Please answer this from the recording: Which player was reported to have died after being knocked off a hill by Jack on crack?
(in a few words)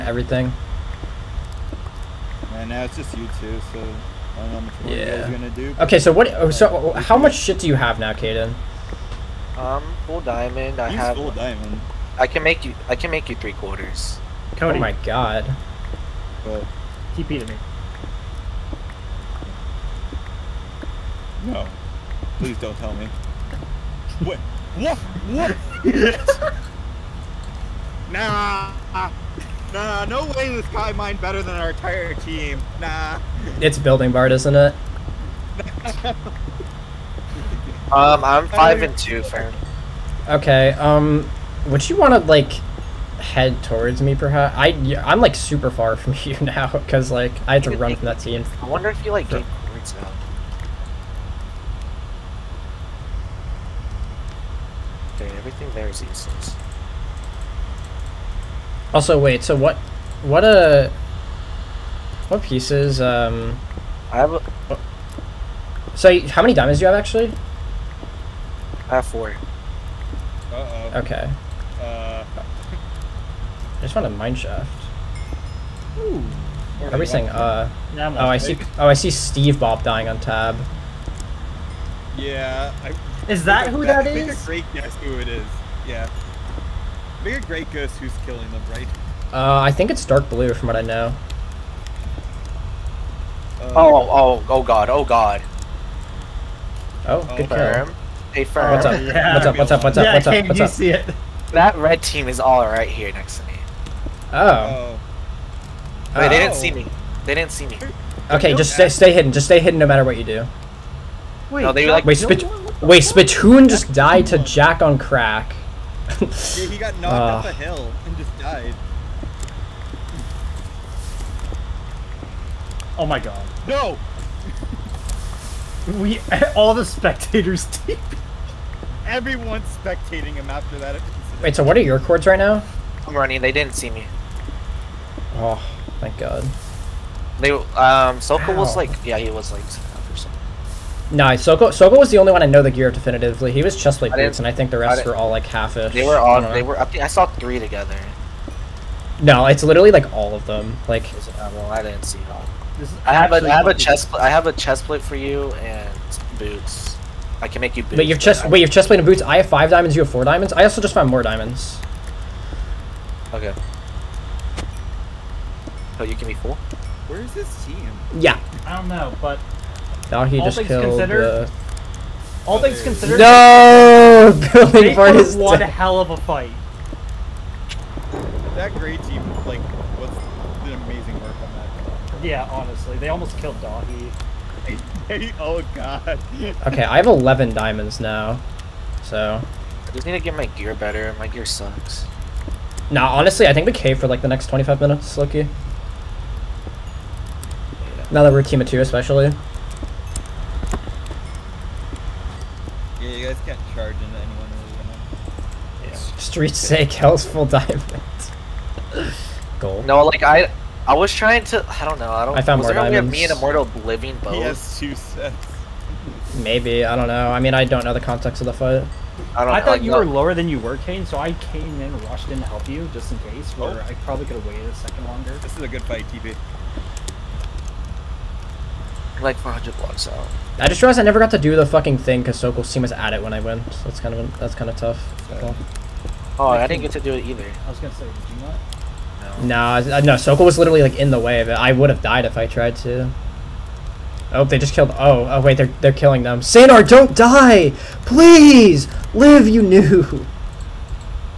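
Spittoon.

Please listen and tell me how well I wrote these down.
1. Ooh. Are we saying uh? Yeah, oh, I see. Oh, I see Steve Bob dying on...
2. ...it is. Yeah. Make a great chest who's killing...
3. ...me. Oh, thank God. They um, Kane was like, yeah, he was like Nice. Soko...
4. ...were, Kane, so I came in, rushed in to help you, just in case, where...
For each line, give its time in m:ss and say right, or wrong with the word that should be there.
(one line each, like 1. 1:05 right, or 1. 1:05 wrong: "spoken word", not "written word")
1. 1:15 right
2. 1:25 wrong: "ghost", not "chest"
3. 2:13 wrong: "Soka", not "Kane"
4. 3:40 right.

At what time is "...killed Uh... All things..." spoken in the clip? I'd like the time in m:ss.
2:50.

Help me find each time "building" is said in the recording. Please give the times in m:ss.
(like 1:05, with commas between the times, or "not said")
0:33, 2:54.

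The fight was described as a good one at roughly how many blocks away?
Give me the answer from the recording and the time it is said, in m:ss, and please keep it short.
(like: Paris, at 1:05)
400 blocks, at 3:49.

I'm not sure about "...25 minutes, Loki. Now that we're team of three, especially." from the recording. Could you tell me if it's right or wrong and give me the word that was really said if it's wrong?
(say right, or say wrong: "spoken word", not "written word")
wrong: "two", not "three".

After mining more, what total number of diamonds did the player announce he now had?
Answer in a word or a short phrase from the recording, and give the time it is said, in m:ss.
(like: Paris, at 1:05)
11, at 3:07.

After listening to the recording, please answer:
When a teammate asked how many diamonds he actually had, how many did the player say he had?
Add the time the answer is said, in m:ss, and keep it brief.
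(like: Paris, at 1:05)
4, at 1:08.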